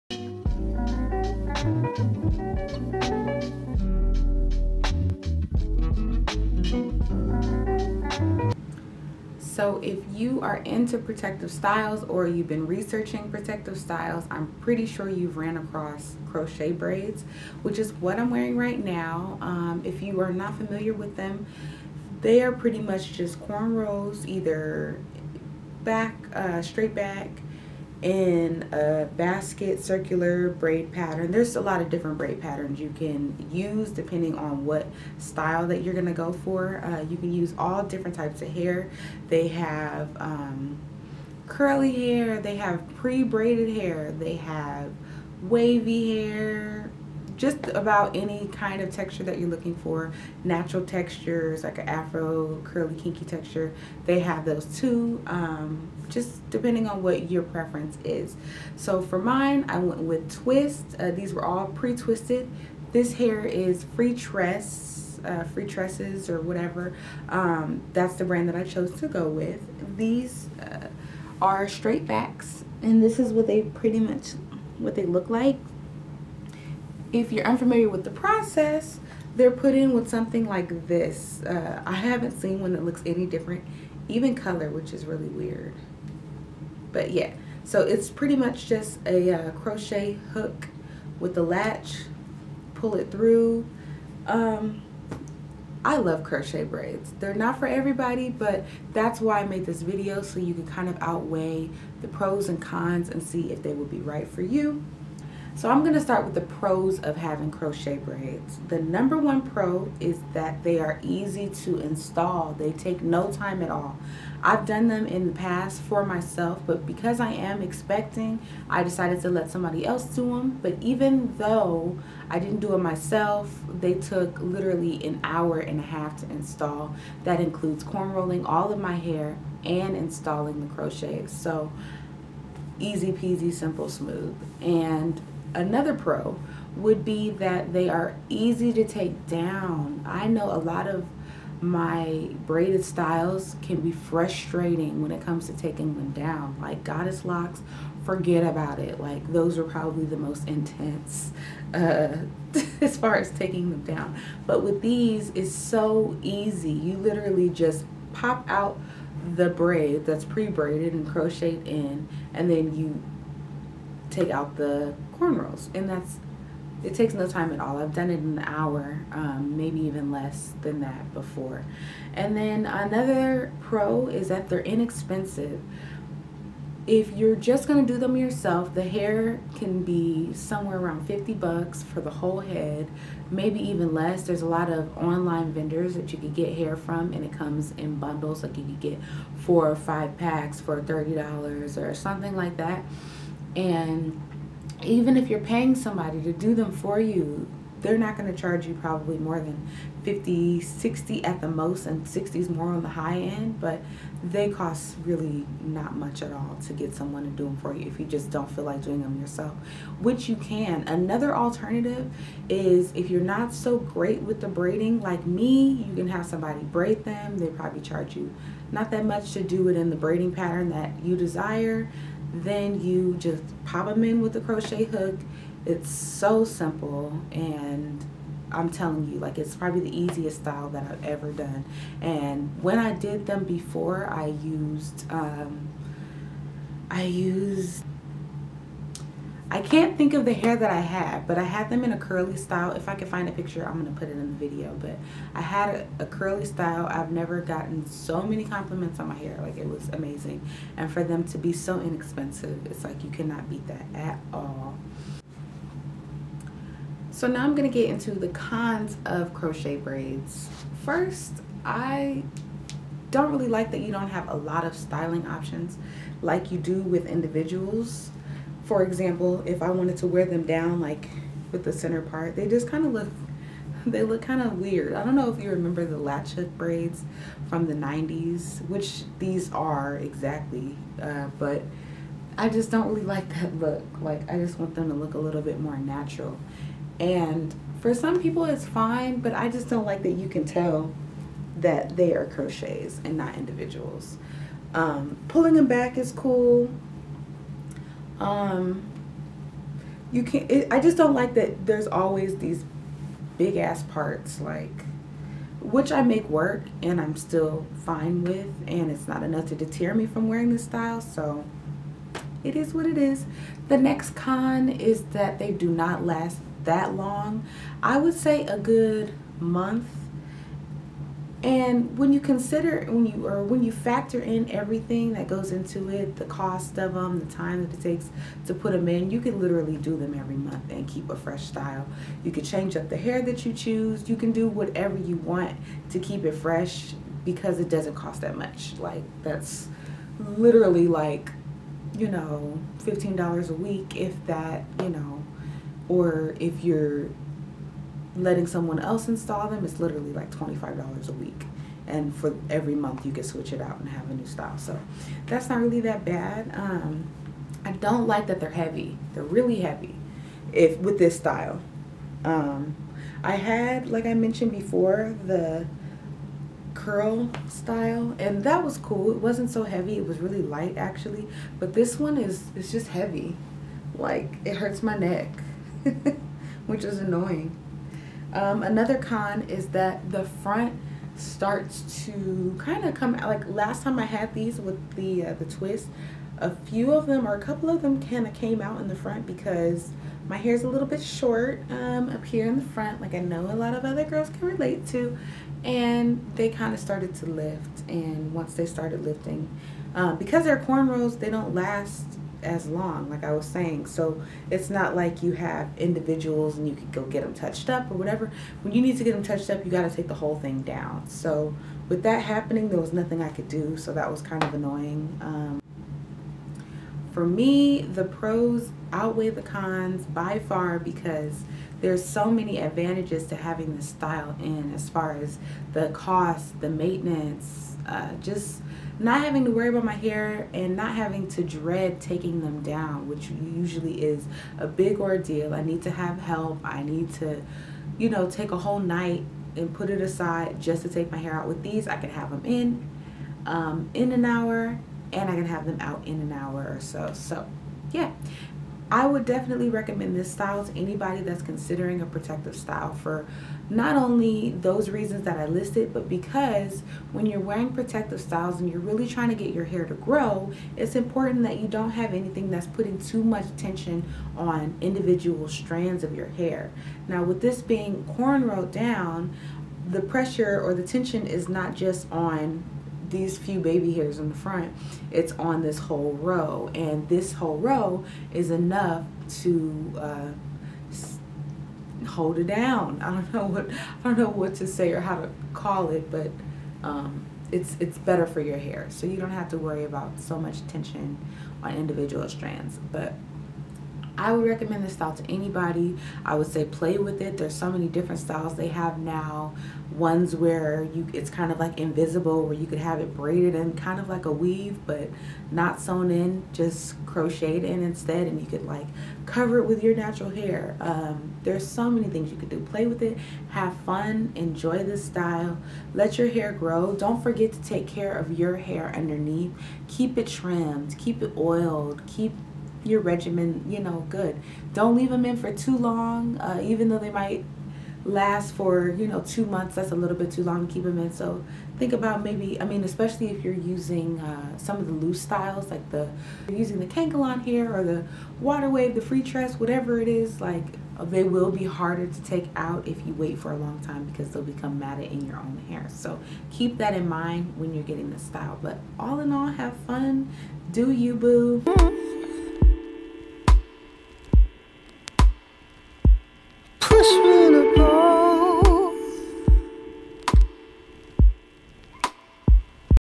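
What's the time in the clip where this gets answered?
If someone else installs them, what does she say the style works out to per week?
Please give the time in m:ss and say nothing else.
5:50.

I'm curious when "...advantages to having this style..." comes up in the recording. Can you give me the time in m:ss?
7:02.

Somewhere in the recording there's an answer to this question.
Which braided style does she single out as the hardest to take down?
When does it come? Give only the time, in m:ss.
2:26.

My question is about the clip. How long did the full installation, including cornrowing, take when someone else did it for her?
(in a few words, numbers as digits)
an hour and a half.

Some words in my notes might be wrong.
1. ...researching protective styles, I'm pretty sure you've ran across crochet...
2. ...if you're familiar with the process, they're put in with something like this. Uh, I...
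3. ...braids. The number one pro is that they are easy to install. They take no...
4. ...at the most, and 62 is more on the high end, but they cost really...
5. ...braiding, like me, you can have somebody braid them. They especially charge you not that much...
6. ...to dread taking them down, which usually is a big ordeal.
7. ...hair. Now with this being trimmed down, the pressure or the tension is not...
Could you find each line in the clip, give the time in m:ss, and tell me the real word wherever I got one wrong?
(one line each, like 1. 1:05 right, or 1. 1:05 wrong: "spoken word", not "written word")
1. 0:12 right
2. 1:17 wrong: "unfamiliar", not "familiar"
3. 1:47 right
4. 3:21 wrong: "60", not "62"
5. 3:34 wrong: "probably", not "especially"
6. 7:11 right
7. 7:46 wrong: "cornrowed", not "trimmed".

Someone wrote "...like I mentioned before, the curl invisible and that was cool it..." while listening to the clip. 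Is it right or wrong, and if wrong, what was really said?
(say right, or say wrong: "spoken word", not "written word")
wrong: "style", not "invisible".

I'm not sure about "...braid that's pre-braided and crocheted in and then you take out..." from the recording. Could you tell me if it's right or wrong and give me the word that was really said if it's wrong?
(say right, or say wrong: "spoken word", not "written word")
right.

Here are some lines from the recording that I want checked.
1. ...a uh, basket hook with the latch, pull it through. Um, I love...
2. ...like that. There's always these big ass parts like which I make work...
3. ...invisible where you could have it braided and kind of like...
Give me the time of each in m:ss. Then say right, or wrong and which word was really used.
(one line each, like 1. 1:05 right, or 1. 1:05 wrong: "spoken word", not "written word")
1. 1:29 wrong: "crochet", not "basket"
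2. 5:01 right
3. 8:21 right.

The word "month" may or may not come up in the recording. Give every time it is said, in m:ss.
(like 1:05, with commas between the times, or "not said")
5:19, 5:30, 5:52, 8:49.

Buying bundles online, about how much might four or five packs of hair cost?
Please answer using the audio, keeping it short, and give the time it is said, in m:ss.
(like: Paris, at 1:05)
$30, at 3:10.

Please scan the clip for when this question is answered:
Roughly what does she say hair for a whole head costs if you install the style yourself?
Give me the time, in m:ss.
3:01.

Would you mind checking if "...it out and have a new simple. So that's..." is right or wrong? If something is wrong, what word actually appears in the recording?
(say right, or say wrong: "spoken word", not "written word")
wrong: "style", not "simple".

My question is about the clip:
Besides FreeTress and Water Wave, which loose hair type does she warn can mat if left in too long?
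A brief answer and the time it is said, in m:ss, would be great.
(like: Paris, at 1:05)
Kanekalon, at 8:56.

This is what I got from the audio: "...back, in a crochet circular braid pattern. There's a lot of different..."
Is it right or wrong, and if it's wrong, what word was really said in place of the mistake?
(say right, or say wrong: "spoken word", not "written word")
wrong: "basket", not "crochet".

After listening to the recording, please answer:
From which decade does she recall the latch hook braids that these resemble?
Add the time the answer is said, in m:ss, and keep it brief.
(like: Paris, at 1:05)
the 90s, at 4:37.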